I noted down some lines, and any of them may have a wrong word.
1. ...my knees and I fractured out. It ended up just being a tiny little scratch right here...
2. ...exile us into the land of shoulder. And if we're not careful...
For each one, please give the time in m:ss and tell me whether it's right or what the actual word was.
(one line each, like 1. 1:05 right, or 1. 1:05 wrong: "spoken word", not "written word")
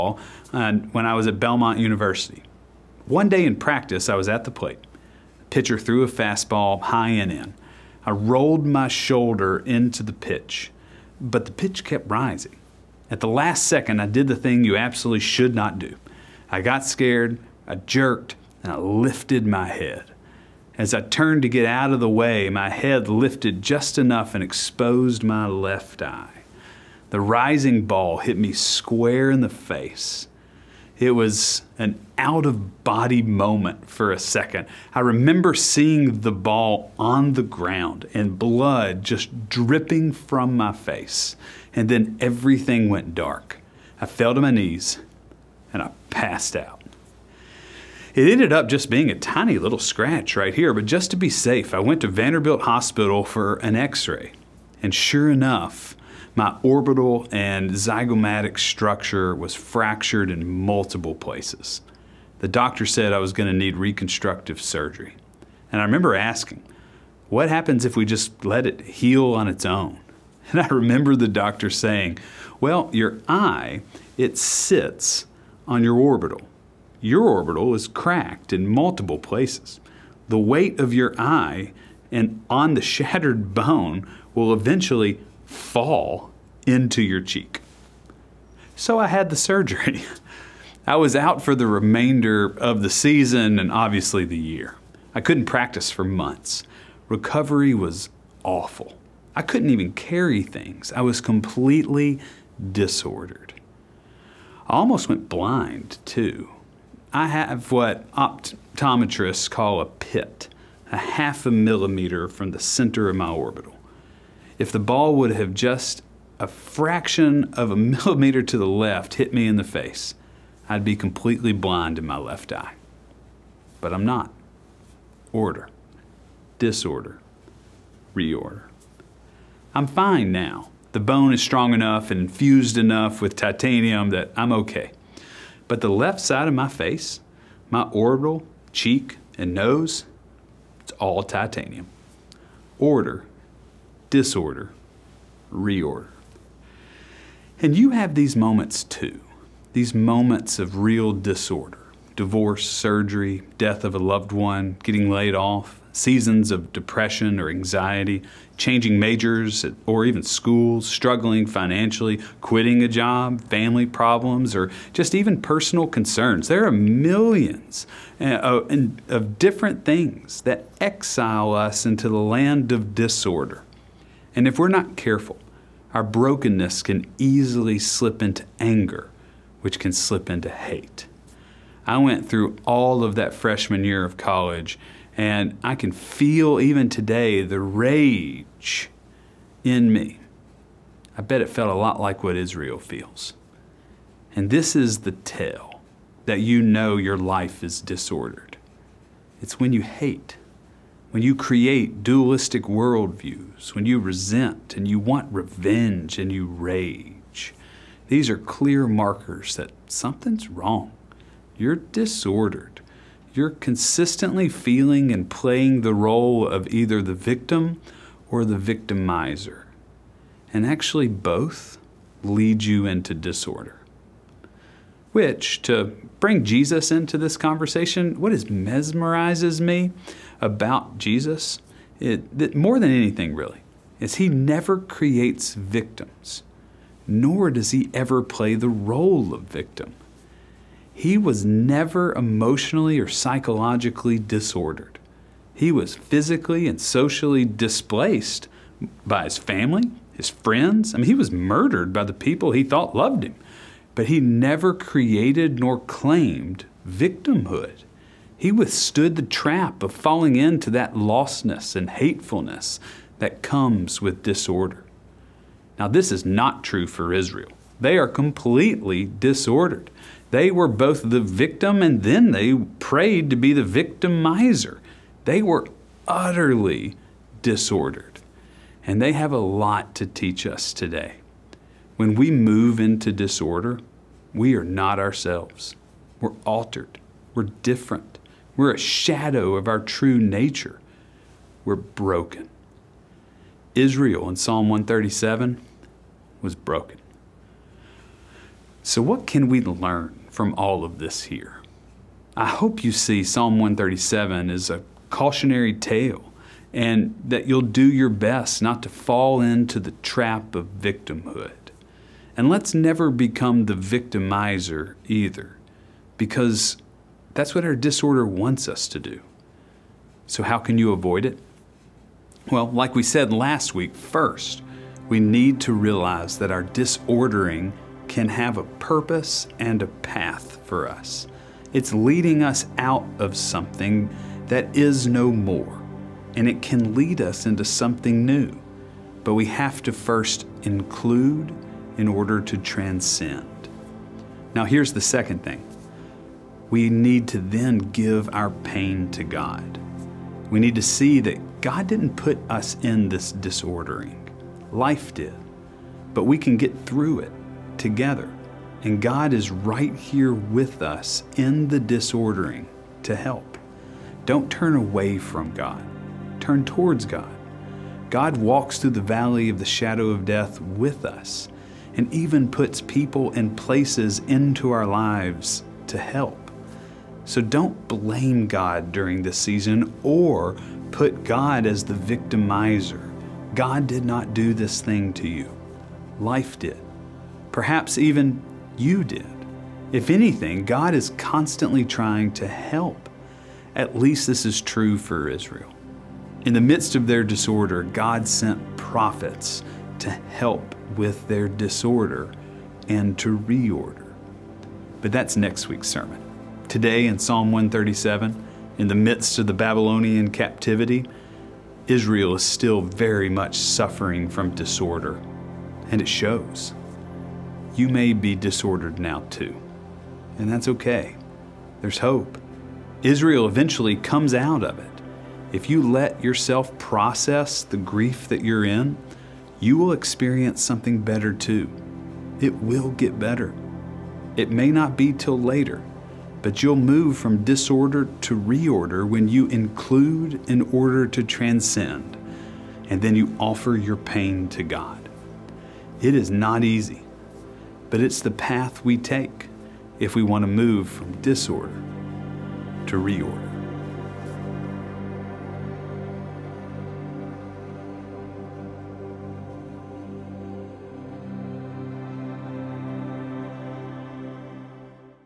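1. 0:44 wrong: "passed", not "fractured"
2. 2:50 wrong: "disorder", not "shoulder".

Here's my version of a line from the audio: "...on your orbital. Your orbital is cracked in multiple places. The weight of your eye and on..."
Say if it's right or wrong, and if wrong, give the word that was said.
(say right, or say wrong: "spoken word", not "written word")
right.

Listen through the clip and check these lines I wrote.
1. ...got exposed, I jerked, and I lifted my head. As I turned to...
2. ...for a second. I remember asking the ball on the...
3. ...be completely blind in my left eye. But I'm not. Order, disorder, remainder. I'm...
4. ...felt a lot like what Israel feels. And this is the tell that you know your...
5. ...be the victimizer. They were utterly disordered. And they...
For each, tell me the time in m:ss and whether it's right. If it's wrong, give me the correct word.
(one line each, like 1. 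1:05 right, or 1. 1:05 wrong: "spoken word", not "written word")
1. 0:16 wrong: "scared", not "exposed"
2. 0:33 wrong: "seeing", not "asking"
3. 2:00 wrong: "reorder", not "remainder"
4. 3:11 right
5. 4:33 right.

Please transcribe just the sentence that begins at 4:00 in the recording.
He was never emotionally or psychologically disordered.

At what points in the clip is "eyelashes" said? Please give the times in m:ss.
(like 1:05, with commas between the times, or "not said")
not said.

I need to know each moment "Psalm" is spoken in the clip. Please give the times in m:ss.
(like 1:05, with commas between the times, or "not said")
4:54, 5:03, 6:47.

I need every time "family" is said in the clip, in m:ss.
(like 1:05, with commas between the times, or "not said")
2:43, 4:09.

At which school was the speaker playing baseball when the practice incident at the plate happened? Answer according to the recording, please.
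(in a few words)
Belmont University.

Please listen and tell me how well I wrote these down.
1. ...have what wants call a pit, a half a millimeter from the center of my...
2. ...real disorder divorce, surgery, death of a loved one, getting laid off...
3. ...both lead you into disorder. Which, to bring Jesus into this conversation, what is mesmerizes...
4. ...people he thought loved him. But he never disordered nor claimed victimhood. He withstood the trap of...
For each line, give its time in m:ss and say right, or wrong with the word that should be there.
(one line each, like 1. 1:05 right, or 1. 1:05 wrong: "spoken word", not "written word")
1. 1:47 wrong: "optometrists", not "wants"
2. 2:30 right
3. 3:41 right
4. 4:12 wrong: "created", not "disordered".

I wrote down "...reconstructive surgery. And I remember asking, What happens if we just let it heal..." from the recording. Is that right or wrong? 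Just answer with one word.
right.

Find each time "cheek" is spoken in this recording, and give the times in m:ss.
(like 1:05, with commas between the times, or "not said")
1:27, 2:18.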